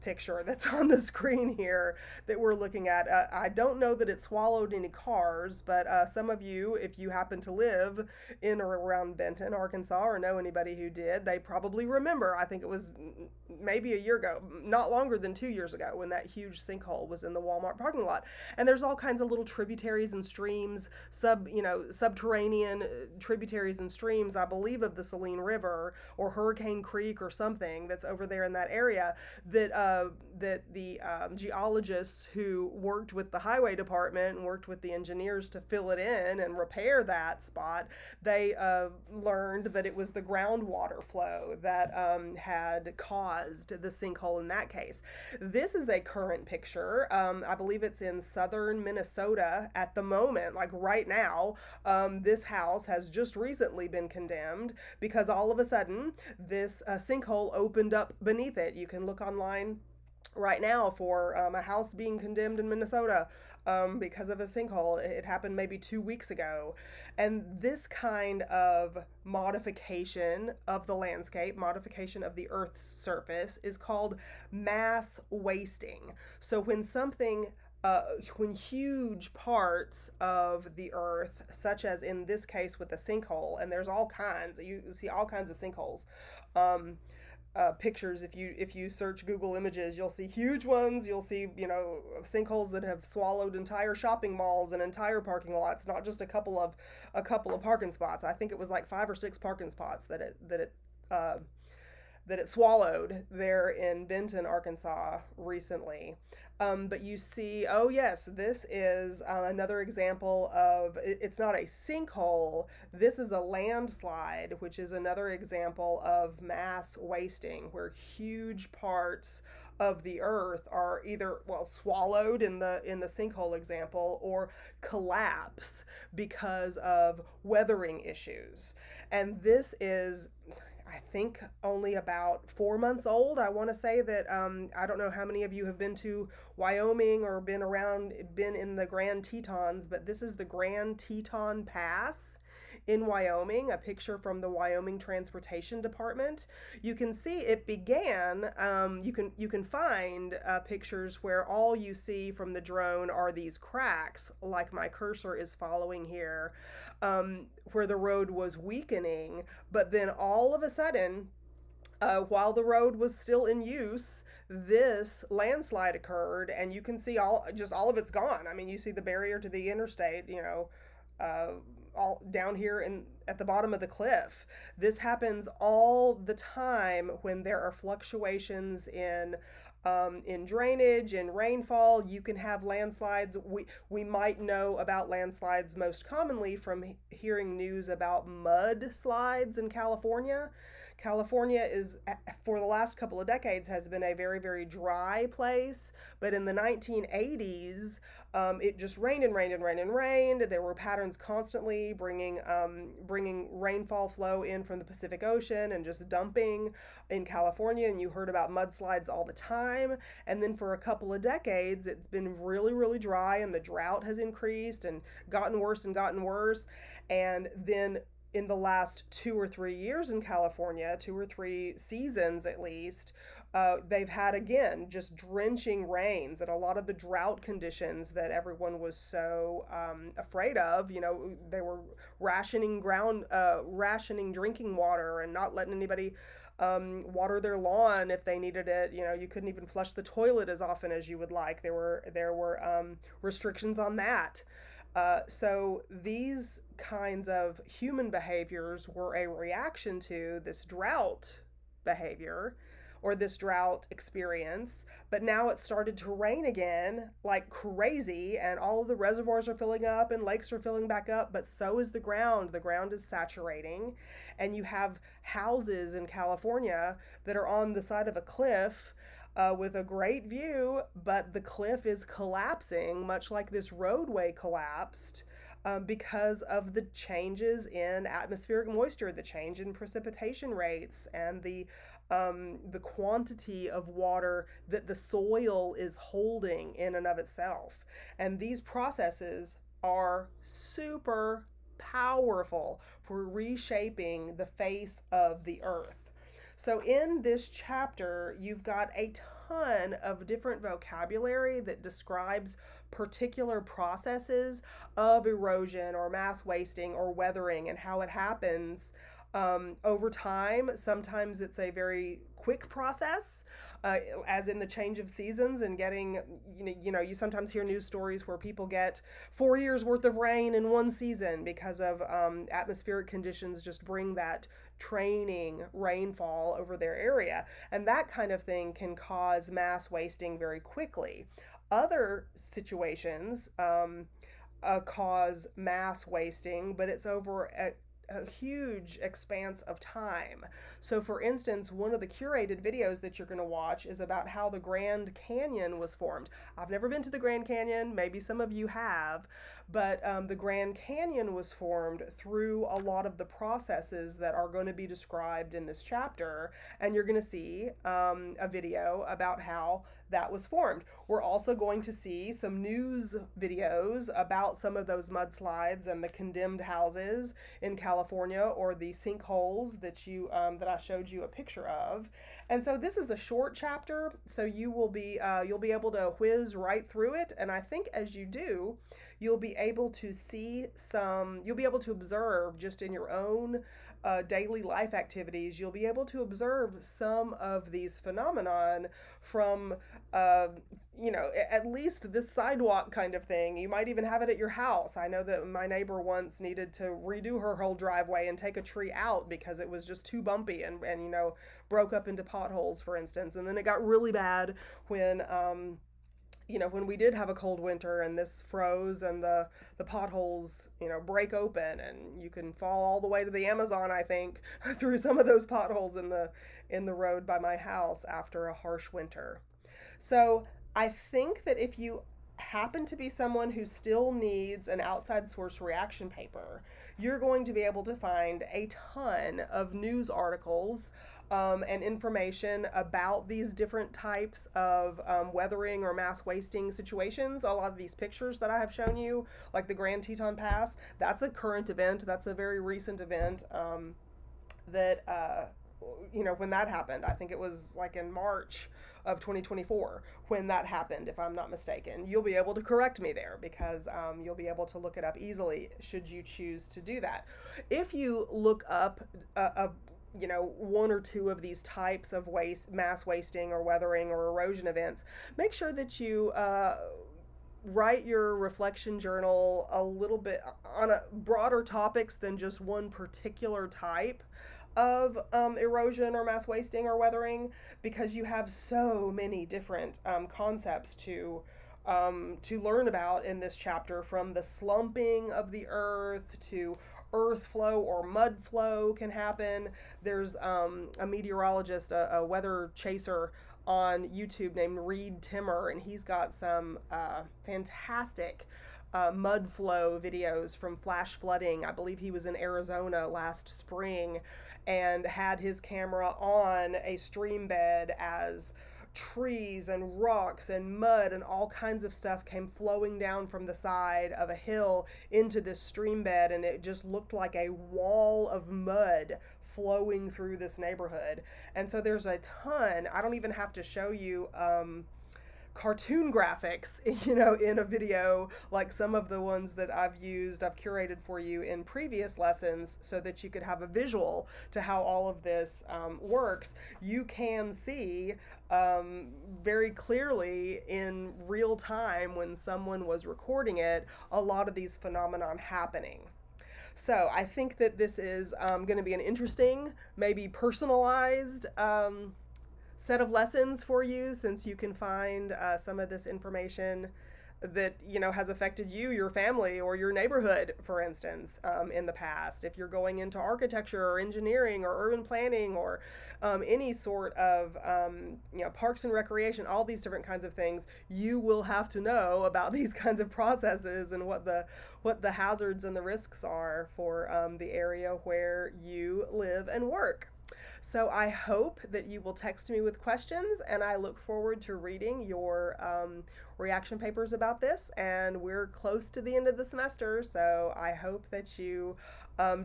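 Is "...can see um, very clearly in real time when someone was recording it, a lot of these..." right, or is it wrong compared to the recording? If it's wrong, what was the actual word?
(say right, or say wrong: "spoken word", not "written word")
right.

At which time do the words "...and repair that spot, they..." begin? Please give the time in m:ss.
0:36.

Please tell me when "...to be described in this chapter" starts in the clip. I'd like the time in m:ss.
5:54.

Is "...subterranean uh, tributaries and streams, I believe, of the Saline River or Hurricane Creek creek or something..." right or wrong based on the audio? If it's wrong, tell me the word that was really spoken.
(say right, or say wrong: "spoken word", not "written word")
right.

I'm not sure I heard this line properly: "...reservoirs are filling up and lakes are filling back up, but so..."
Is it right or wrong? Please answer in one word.
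right.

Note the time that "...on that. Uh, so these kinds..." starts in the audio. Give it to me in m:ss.
4:03.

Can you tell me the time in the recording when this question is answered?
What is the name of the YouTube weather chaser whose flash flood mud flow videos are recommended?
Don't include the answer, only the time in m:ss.
8:14.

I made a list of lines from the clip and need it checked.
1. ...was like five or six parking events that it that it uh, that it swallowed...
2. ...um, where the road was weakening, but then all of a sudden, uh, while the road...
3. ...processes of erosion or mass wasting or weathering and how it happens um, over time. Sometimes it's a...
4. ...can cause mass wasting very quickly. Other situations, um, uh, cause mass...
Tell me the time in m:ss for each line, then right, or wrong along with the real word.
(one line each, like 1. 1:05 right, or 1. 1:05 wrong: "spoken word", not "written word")
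1. 1:38 wrong: "spots", not "events"
2. 2:37 right
3. 5:03 right
4. 5:28 right.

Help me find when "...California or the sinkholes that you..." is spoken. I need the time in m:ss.
6:07.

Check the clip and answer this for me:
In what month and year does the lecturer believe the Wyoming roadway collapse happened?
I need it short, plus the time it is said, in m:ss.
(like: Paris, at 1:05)
March 2024, at 7:28.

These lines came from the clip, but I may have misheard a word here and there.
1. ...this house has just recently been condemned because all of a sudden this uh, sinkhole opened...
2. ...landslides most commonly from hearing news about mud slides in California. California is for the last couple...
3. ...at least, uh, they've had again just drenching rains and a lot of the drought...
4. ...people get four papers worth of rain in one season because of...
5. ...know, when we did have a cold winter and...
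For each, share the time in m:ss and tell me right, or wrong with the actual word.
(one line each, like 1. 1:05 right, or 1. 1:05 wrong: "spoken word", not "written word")
1. 0:52 right
2. 3:05 right
3. 3:42 right
4. 5:18 wrong: "years", not "papers"
5. 6:46 right.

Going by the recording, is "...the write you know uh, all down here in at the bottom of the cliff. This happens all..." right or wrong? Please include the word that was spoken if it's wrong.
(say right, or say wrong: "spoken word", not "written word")
wrong: "interstate", not "write".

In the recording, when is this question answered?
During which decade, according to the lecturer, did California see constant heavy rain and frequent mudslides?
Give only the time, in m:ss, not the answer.
3:16.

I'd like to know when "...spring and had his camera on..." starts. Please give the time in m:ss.
8:23.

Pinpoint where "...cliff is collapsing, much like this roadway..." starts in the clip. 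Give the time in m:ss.
4:31.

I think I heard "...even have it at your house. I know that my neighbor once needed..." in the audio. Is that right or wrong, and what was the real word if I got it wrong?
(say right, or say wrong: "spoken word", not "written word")
right.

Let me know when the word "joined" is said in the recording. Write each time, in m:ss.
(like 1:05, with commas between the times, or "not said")
not said.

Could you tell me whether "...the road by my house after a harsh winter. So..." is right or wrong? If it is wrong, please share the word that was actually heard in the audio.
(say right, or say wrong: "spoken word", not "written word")
right.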